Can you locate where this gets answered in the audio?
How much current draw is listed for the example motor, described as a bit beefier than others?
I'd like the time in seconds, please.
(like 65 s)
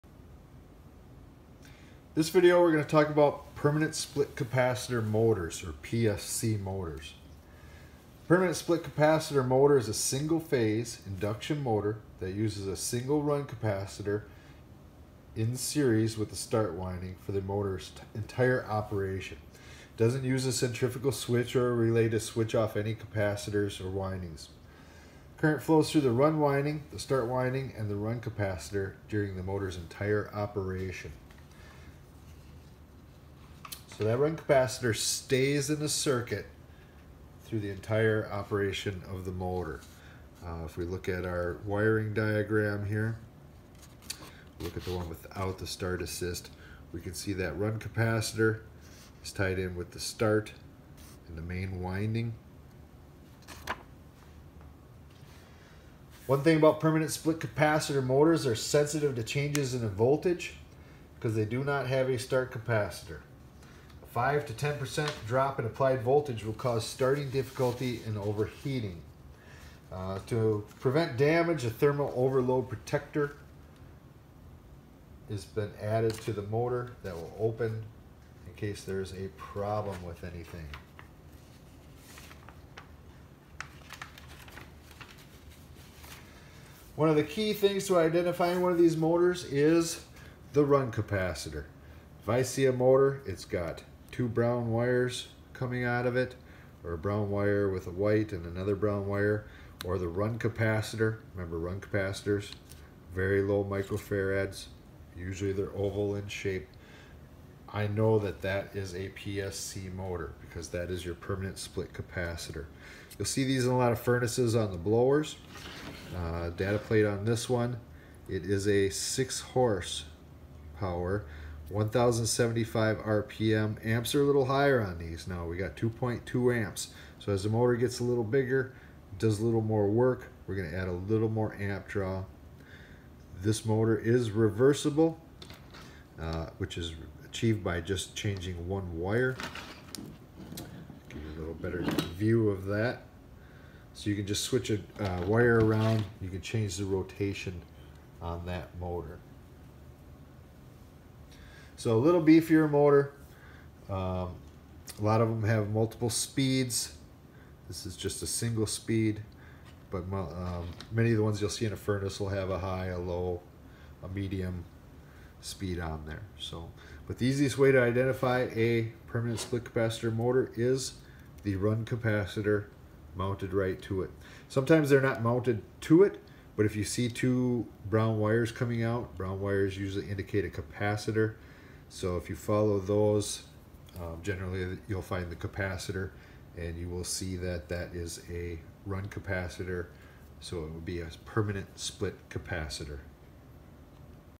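125 s.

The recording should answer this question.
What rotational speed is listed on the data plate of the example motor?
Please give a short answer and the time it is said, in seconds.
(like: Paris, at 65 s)
1075 RPM, at 121 s.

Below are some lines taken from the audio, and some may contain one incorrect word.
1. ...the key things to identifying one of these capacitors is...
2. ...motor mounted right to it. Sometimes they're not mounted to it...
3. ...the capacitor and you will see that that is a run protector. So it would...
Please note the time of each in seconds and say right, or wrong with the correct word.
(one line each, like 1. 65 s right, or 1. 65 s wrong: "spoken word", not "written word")
1. 87 s wrong: "motors", not "capacitors"
2. 171 s wrong: "capacitor", not "motor"
3. 185 s wrong: "capacitor", not "protector".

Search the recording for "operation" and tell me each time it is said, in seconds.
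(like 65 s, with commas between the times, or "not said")
18 s, 30 s, 38 s.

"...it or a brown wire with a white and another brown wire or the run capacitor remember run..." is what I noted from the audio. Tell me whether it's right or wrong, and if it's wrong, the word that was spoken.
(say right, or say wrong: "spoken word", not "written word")
right.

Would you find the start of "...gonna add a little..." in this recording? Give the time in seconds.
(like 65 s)
130 s.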